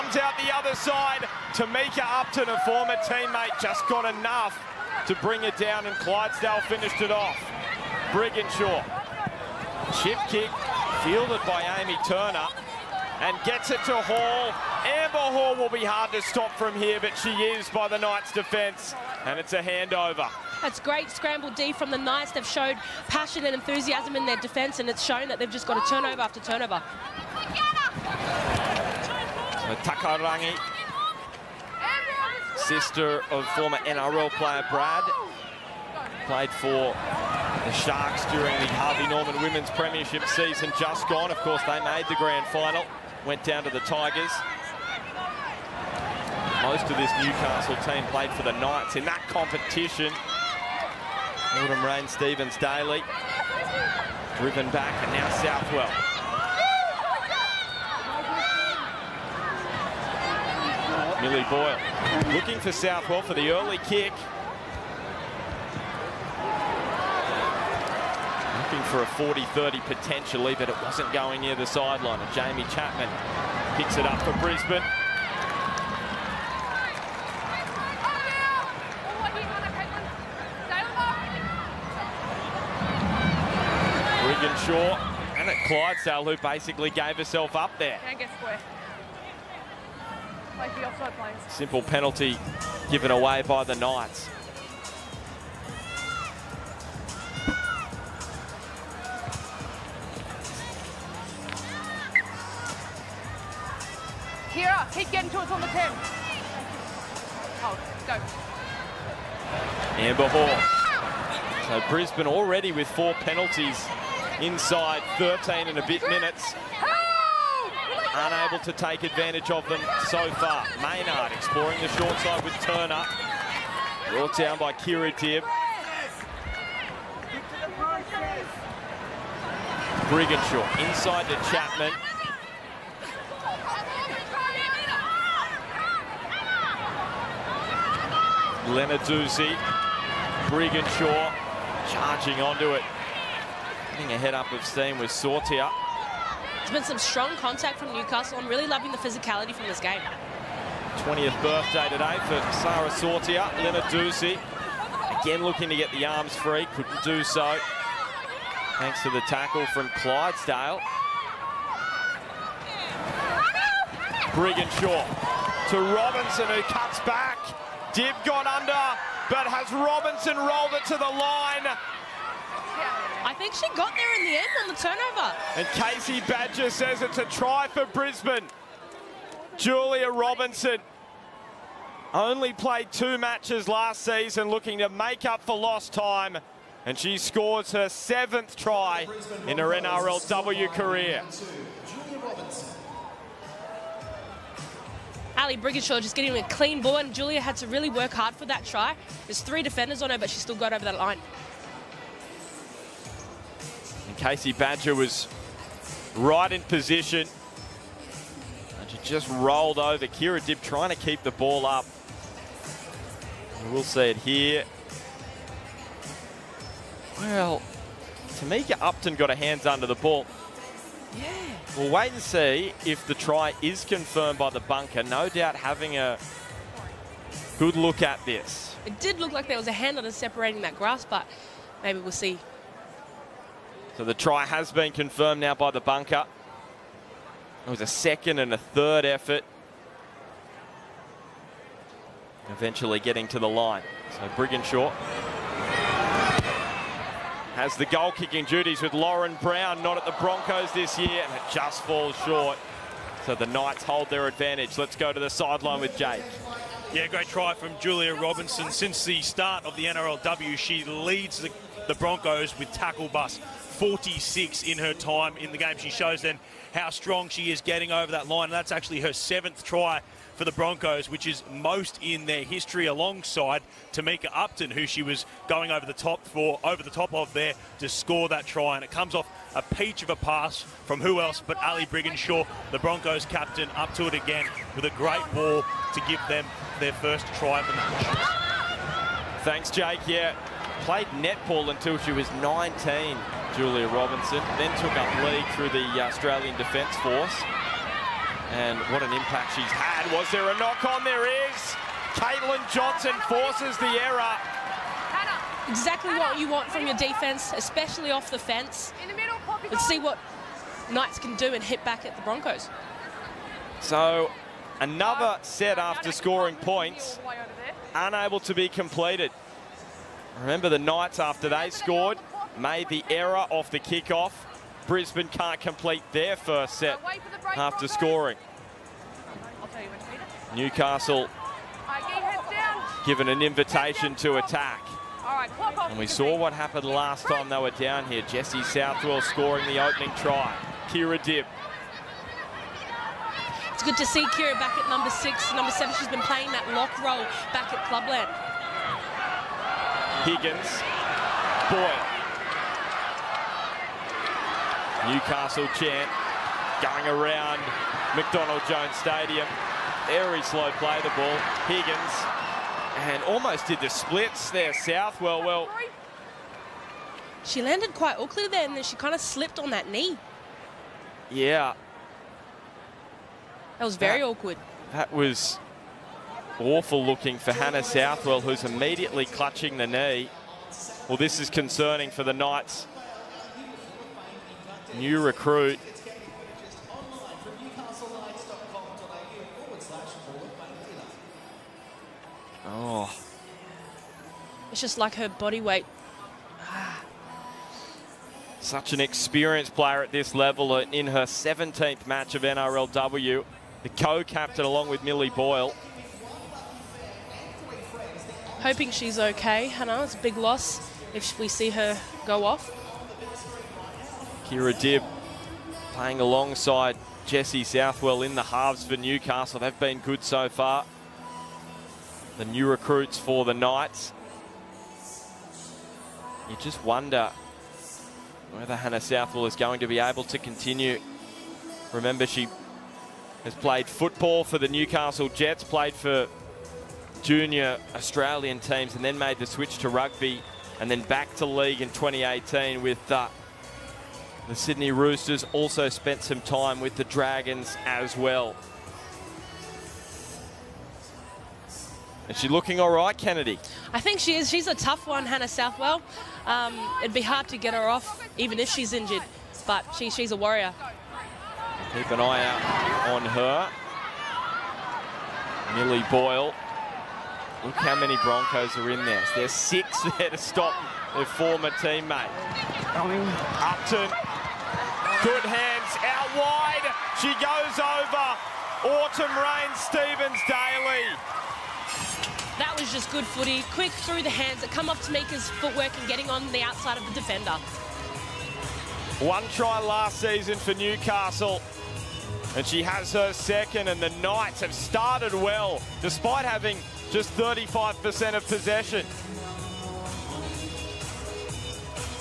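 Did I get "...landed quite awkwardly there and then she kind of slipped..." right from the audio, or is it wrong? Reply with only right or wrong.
right.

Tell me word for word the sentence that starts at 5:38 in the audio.
Jesse Southwell scoring the opening try.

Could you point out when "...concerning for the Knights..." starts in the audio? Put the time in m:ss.
6:21.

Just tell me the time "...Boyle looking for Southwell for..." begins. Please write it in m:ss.
1:01.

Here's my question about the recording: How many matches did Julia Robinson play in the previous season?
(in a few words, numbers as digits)
2.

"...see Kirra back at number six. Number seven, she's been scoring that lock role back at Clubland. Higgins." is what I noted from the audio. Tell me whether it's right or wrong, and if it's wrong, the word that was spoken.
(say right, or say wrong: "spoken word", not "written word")
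wrong: "playing", not "scoring".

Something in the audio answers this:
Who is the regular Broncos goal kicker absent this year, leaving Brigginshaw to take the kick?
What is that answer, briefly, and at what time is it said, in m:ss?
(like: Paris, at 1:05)
Lauren Brown, at 4:08.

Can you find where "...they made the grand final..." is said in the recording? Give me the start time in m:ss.
0:41.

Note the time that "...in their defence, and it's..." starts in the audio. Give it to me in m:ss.
0:24.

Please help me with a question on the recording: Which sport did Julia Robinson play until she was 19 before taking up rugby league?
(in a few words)
Netball.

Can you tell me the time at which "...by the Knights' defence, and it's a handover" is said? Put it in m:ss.
0:17.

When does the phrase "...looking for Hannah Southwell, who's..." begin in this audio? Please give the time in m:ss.
6:17.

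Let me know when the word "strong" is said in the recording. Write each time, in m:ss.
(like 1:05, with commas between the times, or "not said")
2:26, 4:26.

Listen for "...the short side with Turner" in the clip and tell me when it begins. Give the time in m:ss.
2:01.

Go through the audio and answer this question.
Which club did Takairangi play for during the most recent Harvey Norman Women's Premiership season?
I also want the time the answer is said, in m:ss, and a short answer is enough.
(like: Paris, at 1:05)
Sharks, at 0:37.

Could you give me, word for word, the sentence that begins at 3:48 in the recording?
It did look like there was a hand that is separating that grass, but maybe we'll see.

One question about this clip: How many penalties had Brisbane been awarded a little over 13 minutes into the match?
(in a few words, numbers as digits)
4.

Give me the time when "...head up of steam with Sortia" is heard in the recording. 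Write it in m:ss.
2:24.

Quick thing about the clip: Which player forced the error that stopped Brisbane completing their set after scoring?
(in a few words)
Caitlin Johnston.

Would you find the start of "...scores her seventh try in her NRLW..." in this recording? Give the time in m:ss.
3:07.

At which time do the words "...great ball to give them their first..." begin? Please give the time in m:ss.
4:44.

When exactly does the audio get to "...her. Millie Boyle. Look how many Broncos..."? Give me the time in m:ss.
7:43.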